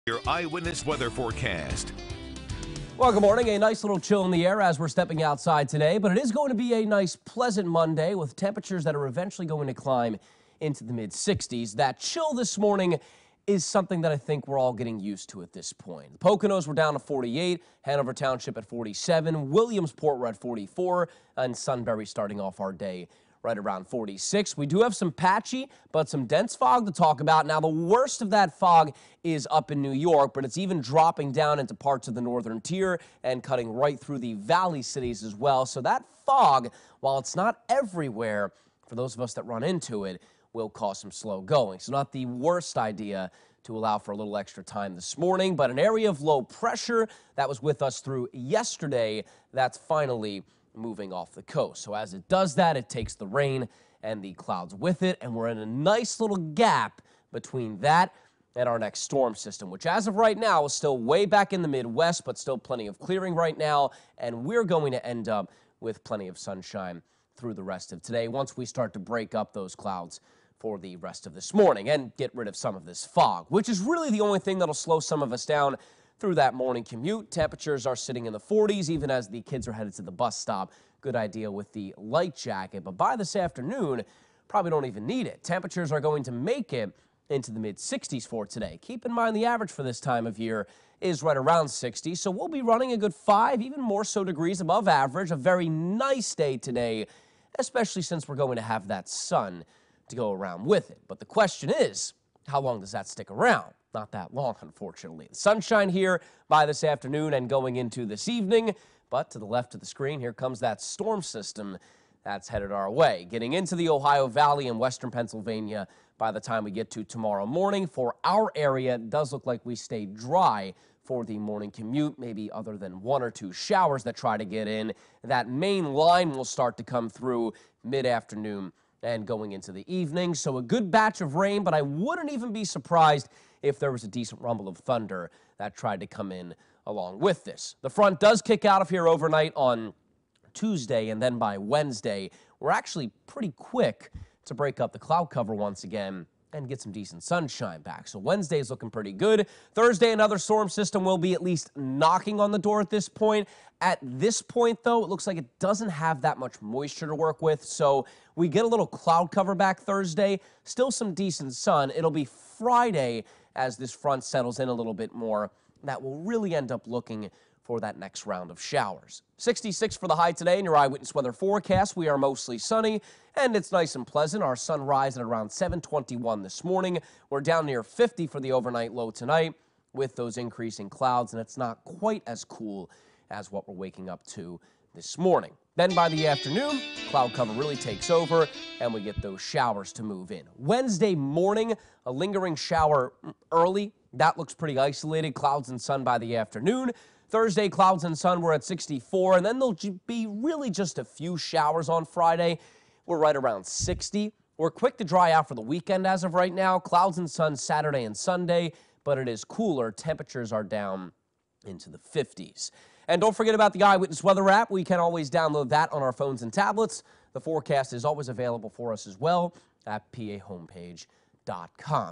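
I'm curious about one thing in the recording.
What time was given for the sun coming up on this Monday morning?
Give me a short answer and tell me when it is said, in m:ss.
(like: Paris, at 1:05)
7:21, at 2:55.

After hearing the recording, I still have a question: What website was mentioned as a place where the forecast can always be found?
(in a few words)
pahomepage.com.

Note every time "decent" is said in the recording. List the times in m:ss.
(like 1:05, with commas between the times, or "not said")
2:14, 2:26, 2:41.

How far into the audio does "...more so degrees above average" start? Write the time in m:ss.
1:33.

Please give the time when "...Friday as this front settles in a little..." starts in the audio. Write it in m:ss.
2:42.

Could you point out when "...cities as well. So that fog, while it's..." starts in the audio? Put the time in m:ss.
0:34.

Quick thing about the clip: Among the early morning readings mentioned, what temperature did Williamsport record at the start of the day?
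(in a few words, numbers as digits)
44.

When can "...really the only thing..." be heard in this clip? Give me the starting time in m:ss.
1:13.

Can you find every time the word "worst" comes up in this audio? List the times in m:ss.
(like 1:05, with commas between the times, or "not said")
0:27, 0:42.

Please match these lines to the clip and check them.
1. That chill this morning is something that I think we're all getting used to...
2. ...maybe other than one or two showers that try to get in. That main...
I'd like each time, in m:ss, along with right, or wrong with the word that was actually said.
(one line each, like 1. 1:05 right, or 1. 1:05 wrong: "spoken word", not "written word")
1. 0:11 right
2. 2:02 right.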